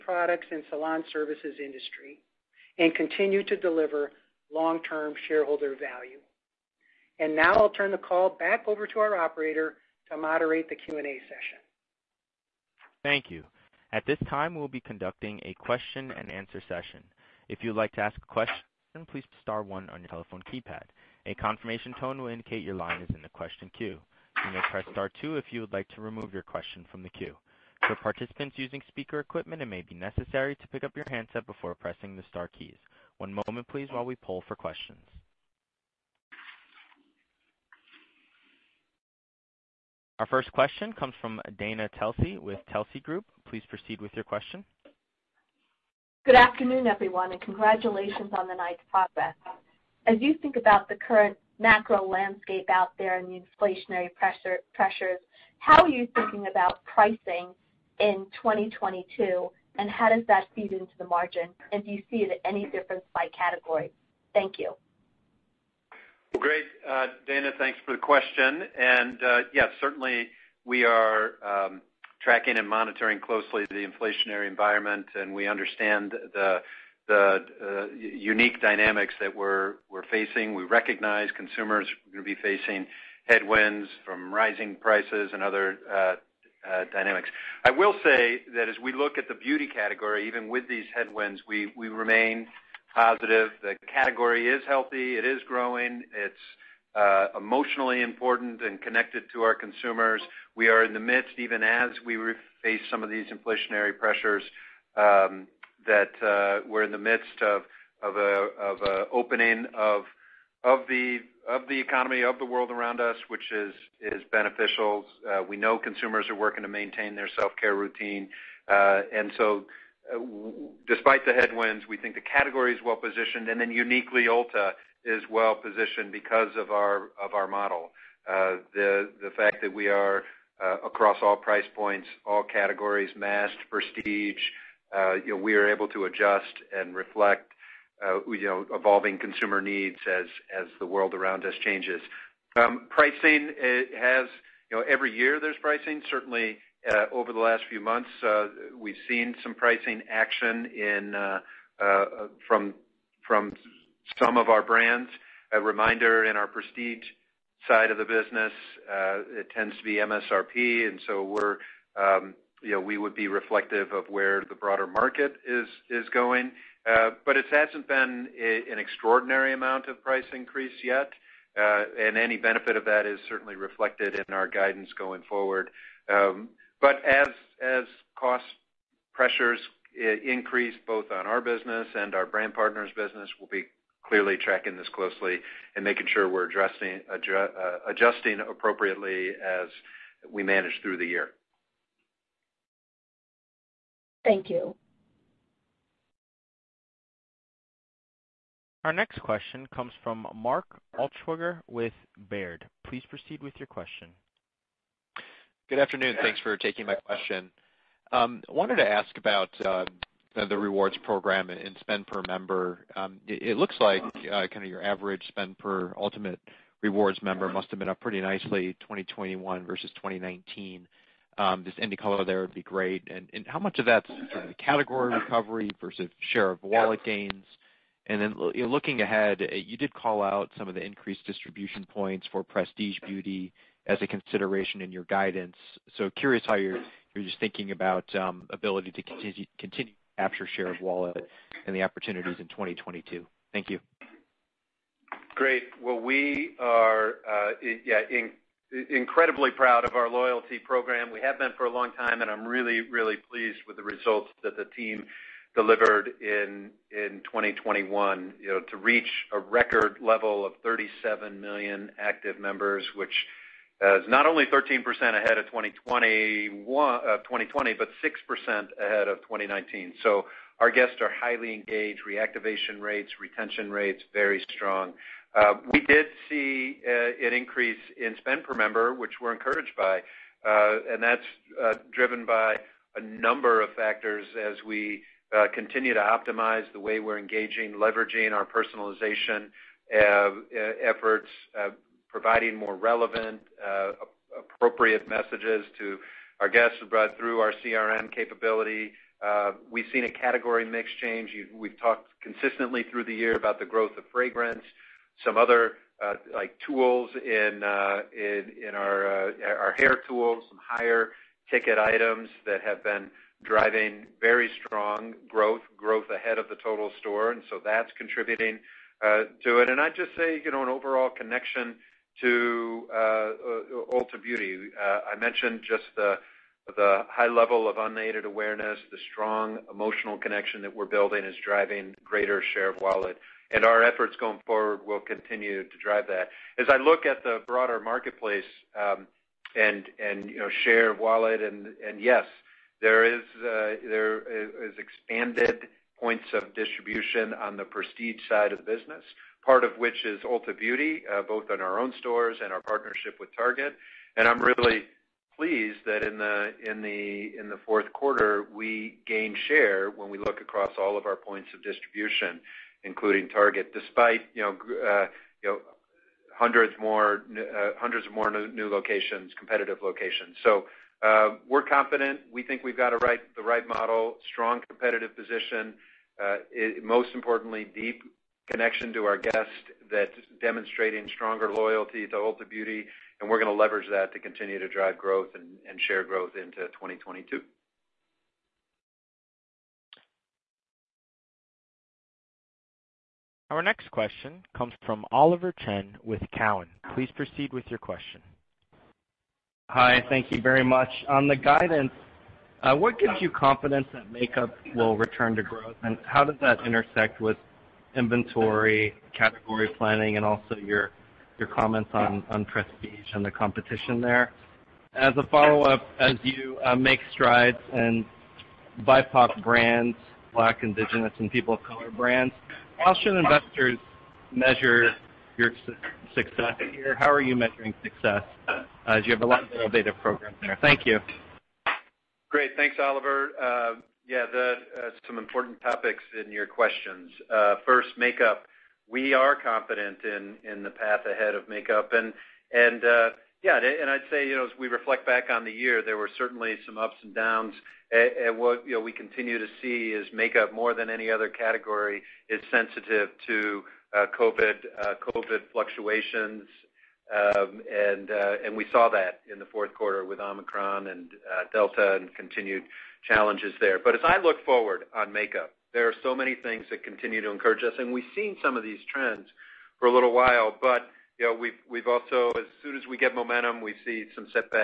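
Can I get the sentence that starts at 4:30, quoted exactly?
So Our guests are highly engaged.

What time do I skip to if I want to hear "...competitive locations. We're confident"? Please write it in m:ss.
6:09.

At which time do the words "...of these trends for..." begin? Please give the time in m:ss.
7:48.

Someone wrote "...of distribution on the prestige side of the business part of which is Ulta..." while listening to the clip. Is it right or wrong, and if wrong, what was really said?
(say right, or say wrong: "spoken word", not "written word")
right.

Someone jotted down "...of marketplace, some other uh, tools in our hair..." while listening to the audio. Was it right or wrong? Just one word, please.
wrong.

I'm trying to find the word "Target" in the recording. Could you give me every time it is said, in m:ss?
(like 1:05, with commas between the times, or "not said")
5:53, 6:03.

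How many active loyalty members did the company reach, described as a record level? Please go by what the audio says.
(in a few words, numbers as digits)
37 million.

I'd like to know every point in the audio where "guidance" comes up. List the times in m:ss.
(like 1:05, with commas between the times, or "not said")
2:54, 3:55, 6:41.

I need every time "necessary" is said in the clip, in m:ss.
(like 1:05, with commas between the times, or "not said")
0:29.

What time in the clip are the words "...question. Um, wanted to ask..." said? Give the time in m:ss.
3:26.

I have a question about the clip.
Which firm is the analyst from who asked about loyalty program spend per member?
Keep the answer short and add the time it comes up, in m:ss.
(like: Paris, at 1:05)
Baird, at 3:22.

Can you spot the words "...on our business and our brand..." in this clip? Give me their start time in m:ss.
3:01.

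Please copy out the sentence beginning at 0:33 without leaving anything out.
One moment please while we poll for questions.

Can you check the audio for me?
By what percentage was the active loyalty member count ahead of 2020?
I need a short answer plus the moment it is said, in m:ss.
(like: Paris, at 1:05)
13%, at 4:24.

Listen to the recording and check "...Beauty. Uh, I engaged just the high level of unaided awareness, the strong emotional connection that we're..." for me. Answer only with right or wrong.
wrong.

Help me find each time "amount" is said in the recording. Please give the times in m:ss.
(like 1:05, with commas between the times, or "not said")
2:49.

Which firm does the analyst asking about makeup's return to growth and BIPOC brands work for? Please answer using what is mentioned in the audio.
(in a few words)
Cowen.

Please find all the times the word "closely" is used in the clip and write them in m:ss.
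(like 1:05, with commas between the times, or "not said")
1:13, 3:04.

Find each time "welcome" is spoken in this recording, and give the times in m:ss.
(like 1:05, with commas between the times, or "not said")
not said.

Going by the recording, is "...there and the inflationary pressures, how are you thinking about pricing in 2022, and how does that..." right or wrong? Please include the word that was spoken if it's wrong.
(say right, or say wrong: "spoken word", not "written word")
right.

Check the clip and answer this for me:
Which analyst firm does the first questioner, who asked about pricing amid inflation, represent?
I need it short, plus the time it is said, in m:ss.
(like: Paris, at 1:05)
Telsey Group, at 0:42.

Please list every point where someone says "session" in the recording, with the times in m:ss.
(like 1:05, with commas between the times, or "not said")
0:11, 0:16.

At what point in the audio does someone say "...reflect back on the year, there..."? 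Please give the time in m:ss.
7:24.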